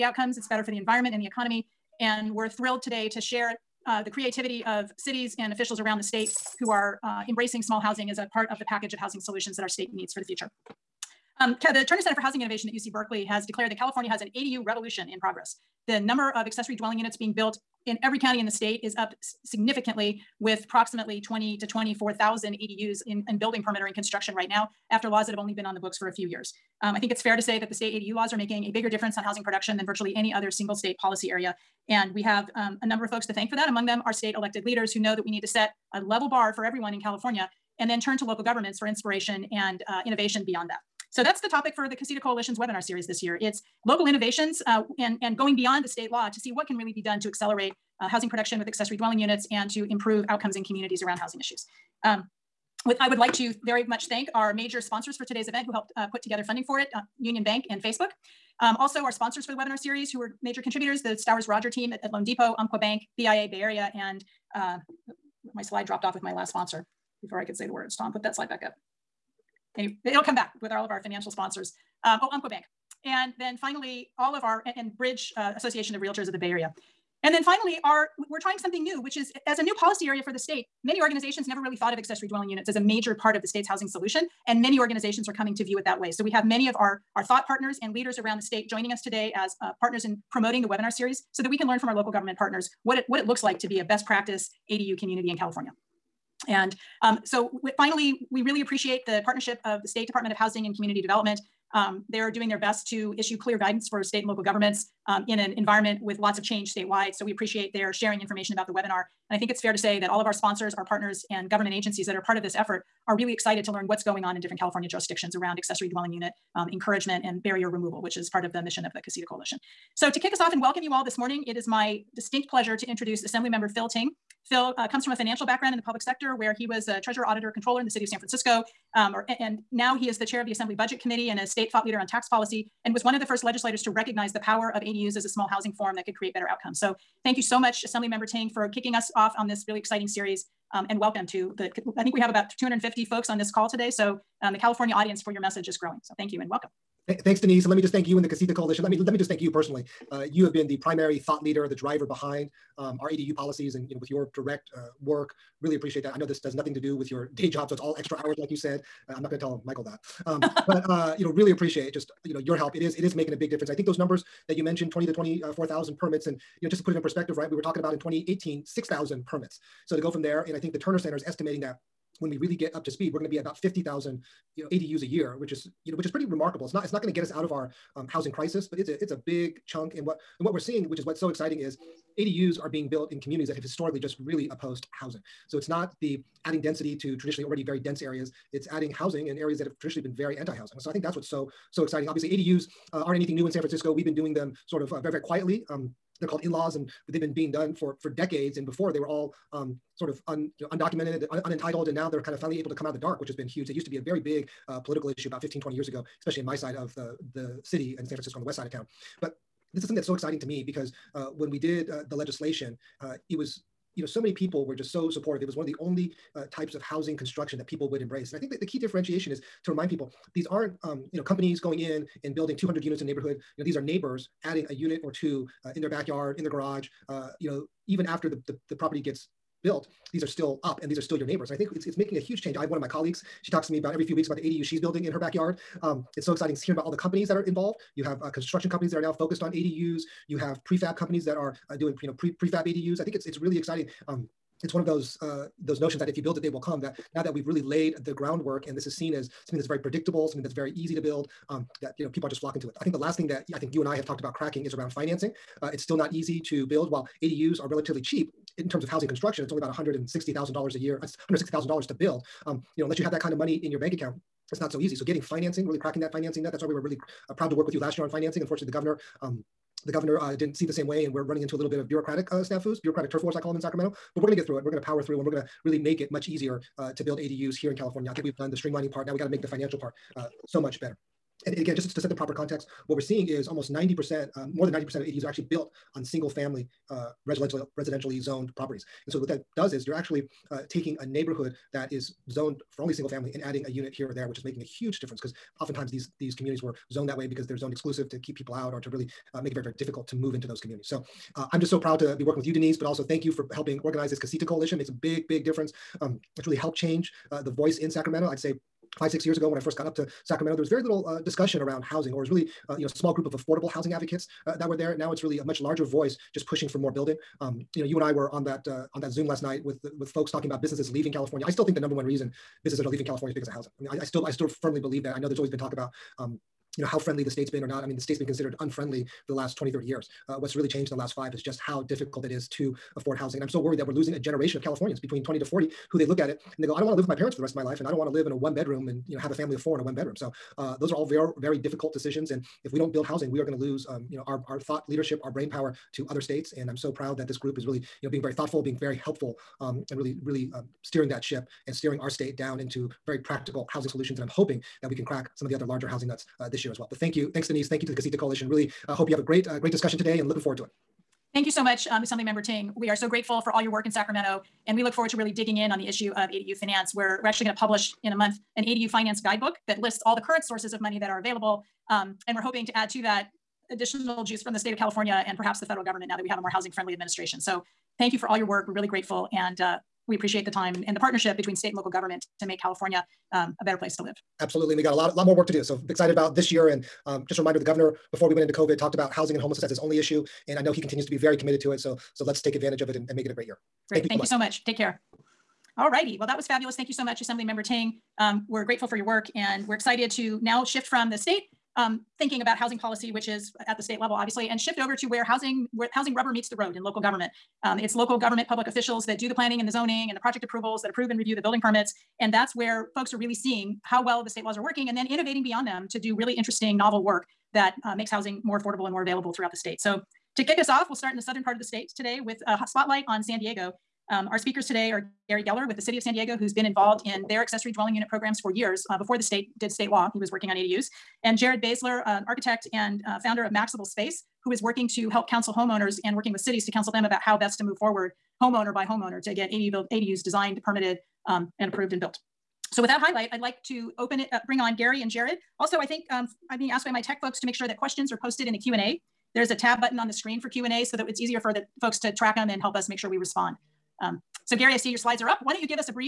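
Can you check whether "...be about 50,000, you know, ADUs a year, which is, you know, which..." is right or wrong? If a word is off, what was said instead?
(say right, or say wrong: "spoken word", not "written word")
right.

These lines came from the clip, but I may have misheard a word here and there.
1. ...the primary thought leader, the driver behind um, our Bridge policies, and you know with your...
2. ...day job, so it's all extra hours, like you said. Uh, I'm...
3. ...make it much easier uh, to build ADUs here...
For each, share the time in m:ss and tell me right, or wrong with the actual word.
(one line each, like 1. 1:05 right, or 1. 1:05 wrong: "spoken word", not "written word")
1. 2:30 wrong: "ADU", not "Bridge"
2. 2:37 right
3. 4:35 right.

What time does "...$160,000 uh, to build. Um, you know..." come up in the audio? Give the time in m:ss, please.
4:21.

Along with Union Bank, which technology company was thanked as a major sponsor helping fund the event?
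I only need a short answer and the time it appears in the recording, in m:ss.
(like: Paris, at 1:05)
Facebook, at 0:57.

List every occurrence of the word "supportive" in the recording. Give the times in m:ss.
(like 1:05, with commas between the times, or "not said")
3:35.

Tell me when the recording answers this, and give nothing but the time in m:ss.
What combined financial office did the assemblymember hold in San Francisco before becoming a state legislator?
2:07.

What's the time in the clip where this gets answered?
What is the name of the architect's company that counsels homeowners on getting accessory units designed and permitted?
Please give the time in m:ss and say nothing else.
7:13.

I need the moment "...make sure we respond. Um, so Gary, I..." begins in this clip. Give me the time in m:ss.
7:32.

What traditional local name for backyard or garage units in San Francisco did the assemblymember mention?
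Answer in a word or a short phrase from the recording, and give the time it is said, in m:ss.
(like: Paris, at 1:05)
in-laws, at 3:16.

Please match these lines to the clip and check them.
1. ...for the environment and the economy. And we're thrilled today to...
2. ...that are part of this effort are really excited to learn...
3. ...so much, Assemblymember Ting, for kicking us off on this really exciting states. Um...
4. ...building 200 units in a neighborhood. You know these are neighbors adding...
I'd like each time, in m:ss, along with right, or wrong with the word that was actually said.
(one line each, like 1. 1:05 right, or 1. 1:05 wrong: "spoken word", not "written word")
1. 0:00 right
2. 1:52 right
3. 2:17 wrong: "series", not "states"
4. 3:42 right.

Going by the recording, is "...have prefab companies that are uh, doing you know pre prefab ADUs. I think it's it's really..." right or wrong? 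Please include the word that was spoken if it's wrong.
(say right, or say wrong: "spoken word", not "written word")
right.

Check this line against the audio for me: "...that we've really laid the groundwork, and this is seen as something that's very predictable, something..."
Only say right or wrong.
right.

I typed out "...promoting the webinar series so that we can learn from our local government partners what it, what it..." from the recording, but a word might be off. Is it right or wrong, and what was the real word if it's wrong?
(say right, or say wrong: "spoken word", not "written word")
right.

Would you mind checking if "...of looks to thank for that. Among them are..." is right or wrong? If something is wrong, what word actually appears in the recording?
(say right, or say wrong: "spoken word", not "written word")
wrong: "folks", not "looks".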